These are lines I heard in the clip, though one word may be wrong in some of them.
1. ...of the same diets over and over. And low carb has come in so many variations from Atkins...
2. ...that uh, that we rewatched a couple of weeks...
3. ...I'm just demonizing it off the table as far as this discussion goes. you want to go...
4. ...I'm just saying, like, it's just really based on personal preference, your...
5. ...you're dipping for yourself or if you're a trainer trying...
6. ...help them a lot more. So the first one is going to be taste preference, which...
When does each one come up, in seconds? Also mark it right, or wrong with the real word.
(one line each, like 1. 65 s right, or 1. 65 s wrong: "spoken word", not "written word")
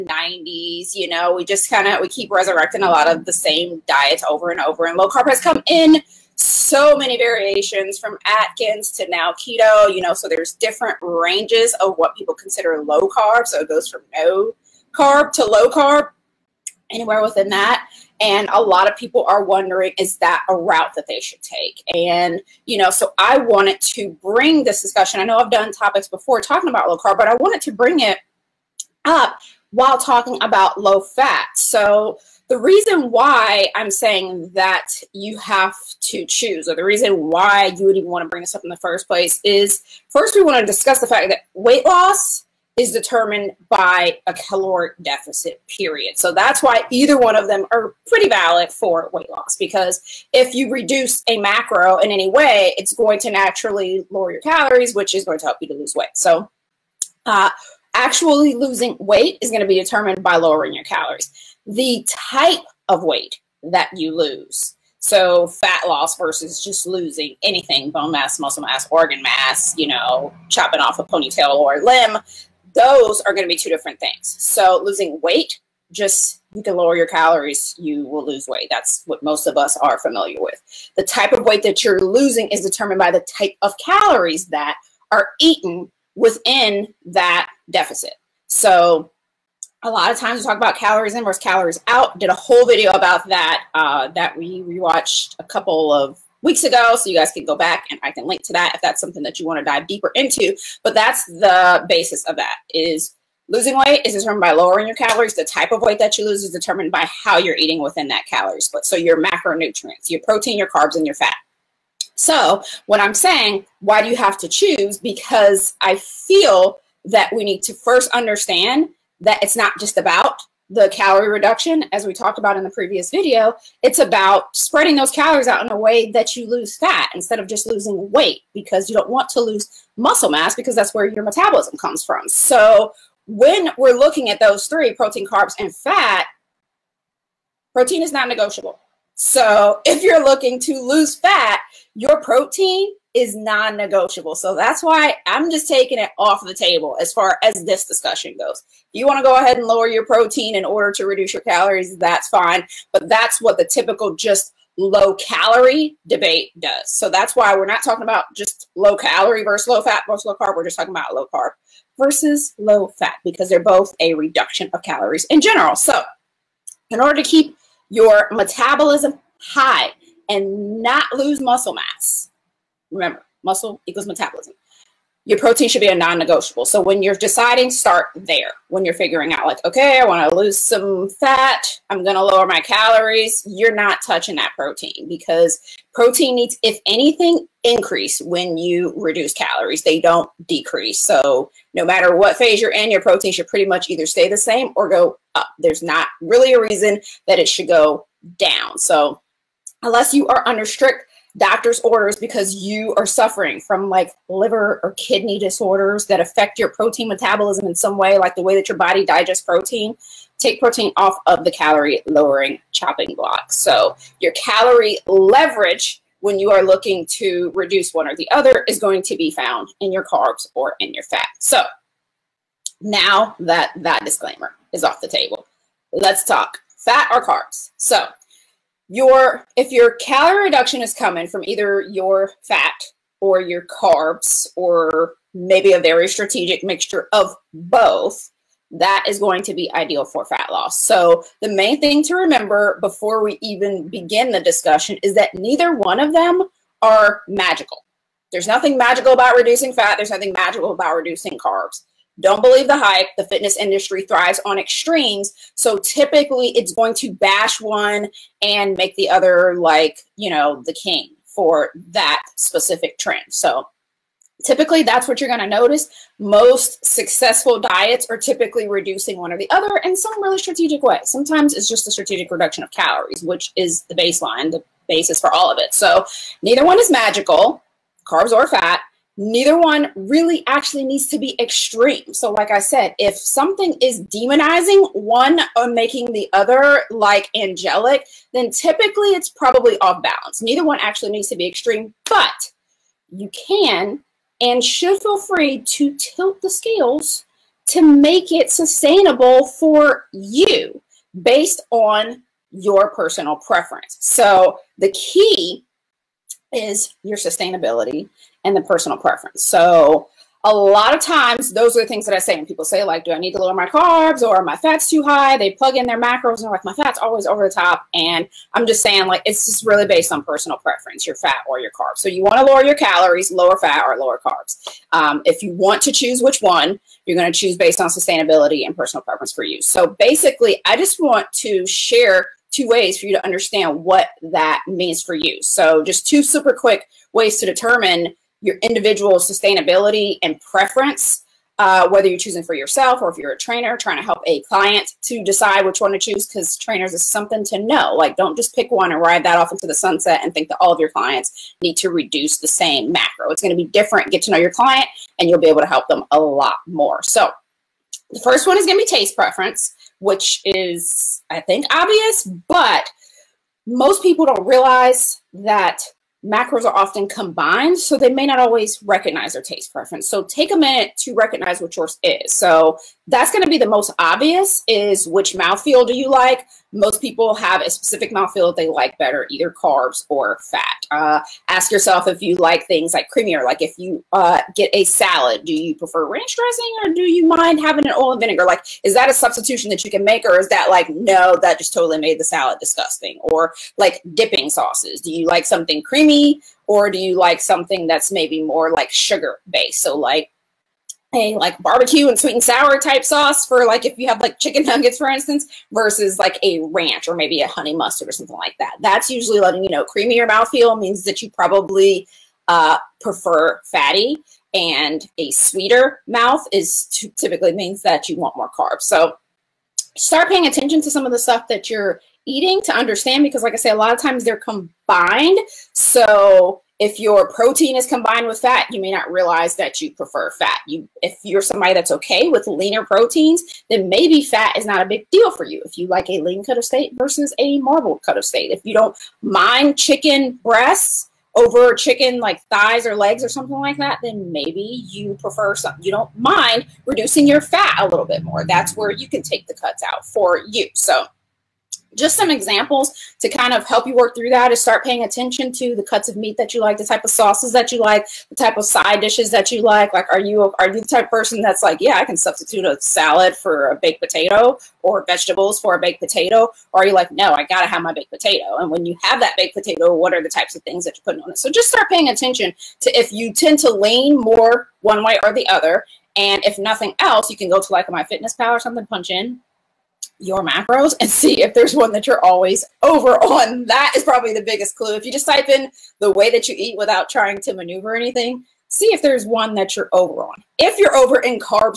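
1. 3 s right
2. 93 s right
3. 145 s wrong: "taking", not "demonizing"
4. 318 s right
5. 342 s wrong: "choosing", not "dipping"
6. 355 s right.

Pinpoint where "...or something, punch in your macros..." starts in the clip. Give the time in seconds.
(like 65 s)
478 s.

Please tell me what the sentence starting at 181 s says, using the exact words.
I'm going to lower my calories.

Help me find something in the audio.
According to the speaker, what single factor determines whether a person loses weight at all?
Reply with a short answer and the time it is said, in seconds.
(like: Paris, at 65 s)
a caloric deficit, at 44 s.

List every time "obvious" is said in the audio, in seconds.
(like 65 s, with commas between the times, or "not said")
361 s, 373 s.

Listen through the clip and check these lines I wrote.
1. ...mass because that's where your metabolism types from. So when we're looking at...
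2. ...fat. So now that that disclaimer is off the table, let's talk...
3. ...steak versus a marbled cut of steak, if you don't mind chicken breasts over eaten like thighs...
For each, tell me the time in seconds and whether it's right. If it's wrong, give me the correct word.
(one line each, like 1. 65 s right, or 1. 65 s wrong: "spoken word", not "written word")
1. 130 s wrong: "comes", not "types"
2. 221 s right
3. 436 s wrong: "chicken", not "eaten".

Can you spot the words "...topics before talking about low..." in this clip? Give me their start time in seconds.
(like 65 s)
25 s.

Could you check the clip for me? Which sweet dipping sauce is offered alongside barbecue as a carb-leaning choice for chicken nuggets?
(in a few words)
sweet and sour.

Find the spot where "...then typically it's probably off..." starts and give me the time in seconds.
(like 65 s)
288 s.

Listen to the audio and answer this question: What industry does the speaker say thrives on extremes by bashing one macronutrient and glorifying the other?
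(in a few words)
the fitness industry.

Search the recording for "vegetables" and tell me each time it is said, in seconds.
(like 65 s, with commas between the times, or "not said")
465 s.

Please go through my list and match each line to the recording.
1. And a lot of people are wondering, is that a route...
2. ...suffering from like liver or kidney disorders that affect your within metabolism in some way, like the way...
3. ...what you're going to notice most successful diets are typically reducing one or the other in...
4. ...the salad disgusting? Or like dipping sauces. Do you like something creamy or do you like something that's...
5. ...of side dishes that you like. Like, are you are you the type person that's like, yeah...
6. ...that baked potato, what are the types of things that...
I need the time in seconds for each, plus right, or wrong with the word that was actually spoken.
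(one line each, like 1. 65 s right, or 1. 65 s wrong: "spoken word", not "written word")
1. 18 s right
2. 203 s wrong: "protein", not "within"
3. 265 s right
4. 392 s right
5. 458 s right
6. 469 s right.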